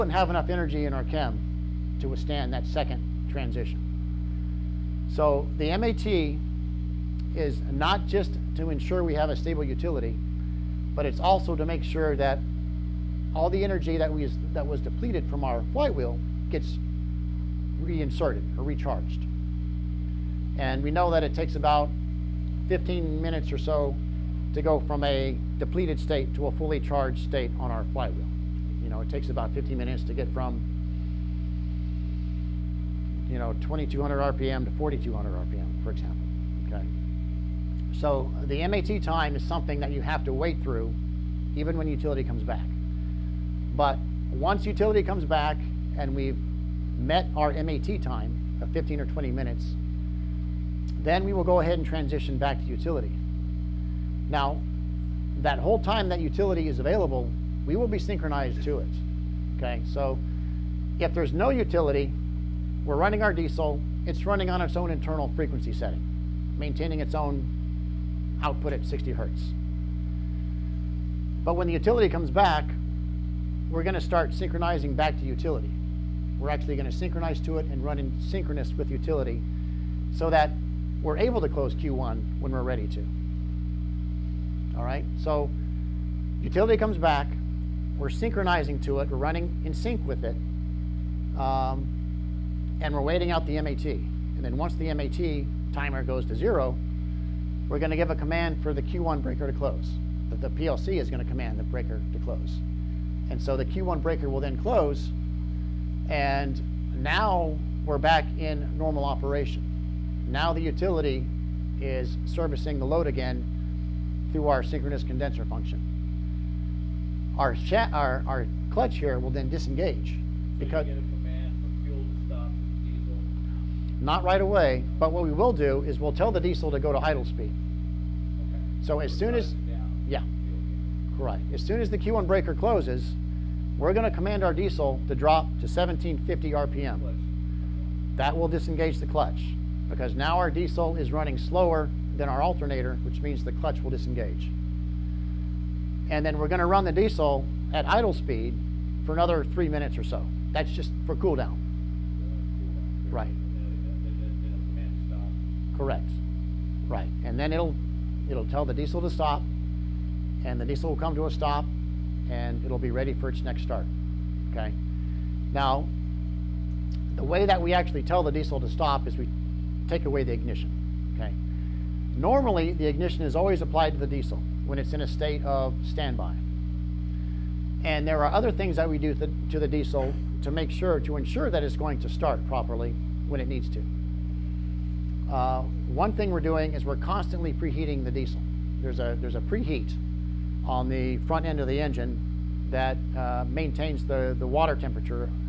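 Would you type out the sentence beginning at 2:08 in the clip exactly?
So as soon as, yeah, right.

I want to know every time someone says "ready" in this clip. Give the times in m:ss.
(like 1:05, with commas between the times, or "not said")
1:22, 2:42.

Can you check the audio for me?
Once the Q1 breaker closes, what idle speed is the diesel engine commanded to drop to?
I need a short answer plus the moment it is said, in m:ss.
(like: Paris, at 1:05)
1750 RPM, at 2:15.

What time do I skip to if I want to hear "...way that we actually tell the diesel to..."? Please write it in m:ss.
2:47.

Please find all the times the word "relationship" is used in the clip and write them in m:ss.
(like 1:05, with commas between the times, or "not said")
not said.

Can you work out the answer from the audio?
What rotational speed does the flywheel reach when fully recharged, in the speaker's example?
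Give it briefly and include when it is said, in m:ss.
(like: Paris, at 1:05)
4200 RPM, at 0:34.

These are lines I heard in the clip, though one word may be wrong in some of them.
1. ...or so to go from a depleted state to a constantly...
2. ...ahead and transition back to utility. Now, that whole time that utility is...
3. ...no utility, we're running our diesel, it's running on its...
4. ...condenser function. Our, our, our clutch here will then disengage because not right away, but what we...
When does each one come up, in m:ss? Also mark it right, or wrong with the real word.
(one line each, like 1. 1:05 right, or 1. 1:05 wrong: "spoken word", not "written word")
1. 0:23 wrong: "fully", not "constantly"
2. 0:51 right
3. 1:01 right
4. 1:55 right.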